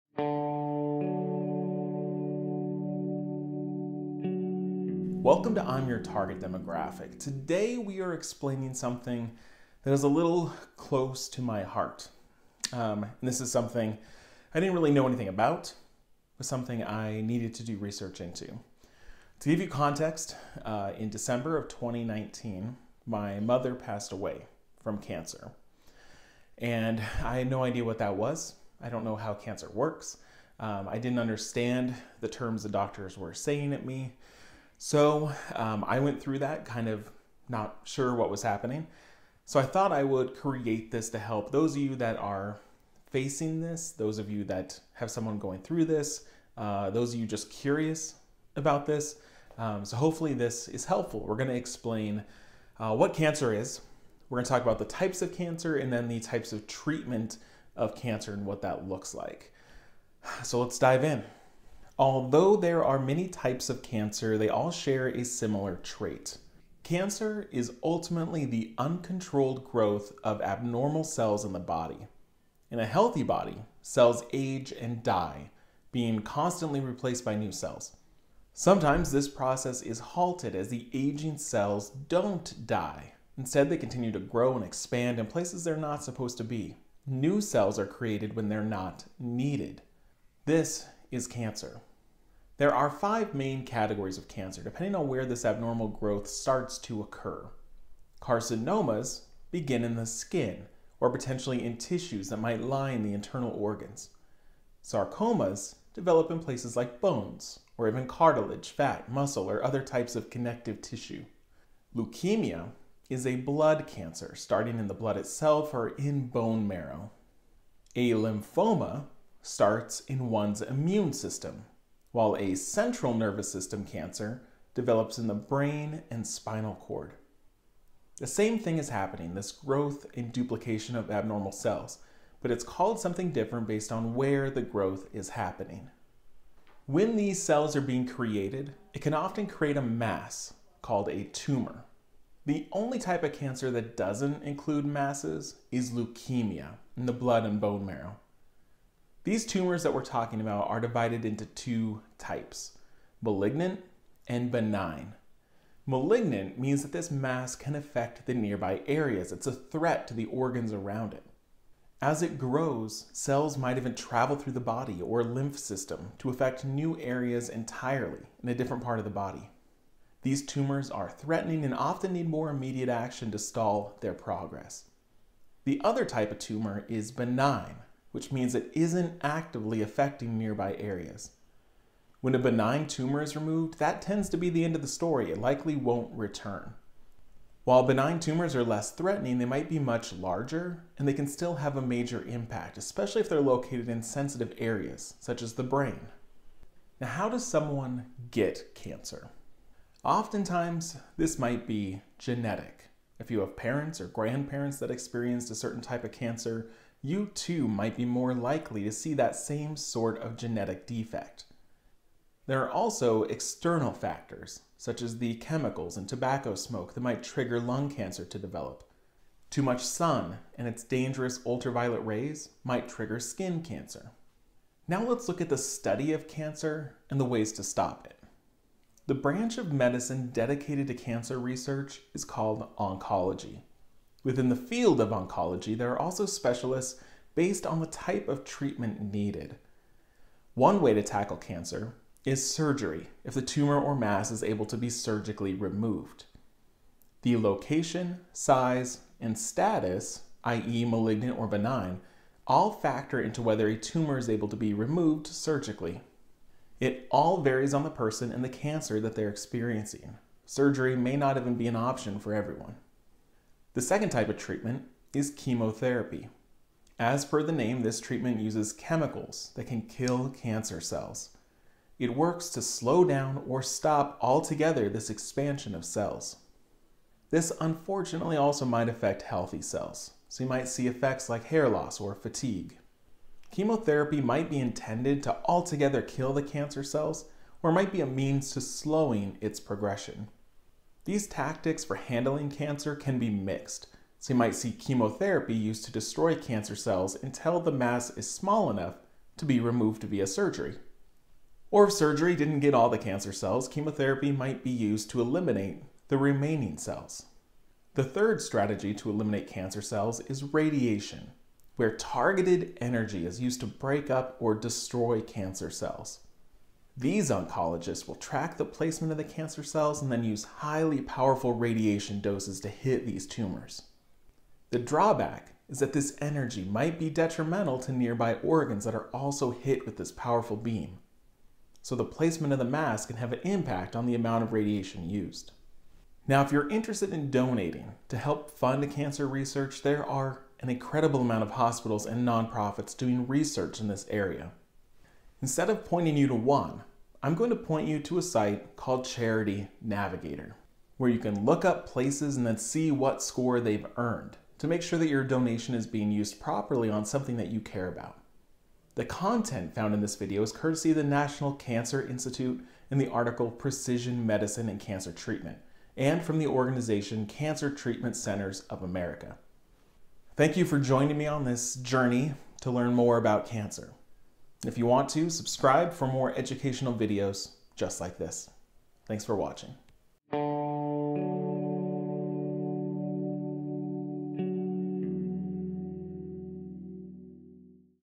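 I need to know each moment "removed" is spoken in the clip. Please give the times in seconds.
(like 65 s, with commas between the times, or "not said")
183 s, 245 s, 254 s, 299 s.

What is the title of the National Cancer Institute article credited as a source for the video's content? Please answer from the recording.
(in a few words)
Precision Medicine and Cancer Treatment.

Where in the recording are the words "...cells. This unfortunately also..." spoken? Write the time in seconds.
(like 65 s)
275 s.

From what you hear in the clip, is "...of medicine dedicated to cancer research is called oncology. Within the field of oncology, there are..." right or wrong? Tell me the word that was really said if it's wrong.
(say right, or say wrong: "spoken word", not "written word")
right.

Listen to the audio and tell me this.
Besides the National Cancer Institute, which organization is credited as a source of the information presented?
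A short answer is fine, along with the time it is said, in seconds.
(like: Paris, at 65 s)
Cancer Treatment Centers of America, at 367 s.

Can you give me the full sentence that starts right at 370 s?
Thank you for joining me on this journey to learn more about cancer.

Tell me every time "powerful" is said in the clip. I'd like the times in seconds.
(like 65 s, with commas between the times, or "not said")
321 s, 330 s.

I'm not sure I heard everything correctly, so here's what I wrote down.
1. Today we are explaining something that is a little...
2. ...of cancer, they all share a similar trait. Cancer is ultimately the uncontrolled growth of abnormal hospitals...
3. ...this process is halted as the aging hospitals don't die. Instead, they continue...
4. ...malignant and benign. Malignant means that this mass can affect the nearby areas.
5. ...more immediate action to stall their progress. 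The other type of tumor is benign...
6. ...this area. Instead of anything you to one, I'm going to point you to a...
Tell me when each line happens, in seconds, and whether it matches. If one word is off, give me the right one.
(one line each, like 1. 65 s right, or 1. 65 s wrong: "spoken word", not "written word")
1. 7 s right
2. 63 s wrong: "cells", not "hospitals"
3. 79 s wrong: "cells", not "hospitals"
4. 153 s right
5. 172 s right
6. 343 s wrong: "pointing", not "anything".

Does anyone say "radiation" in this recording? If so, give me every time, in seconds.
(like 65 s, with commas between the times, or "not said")
310 s, 321 s, 334 s.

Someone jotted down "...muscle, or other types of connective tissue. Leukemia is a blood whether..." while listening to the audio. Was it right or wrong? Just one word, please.
wrong.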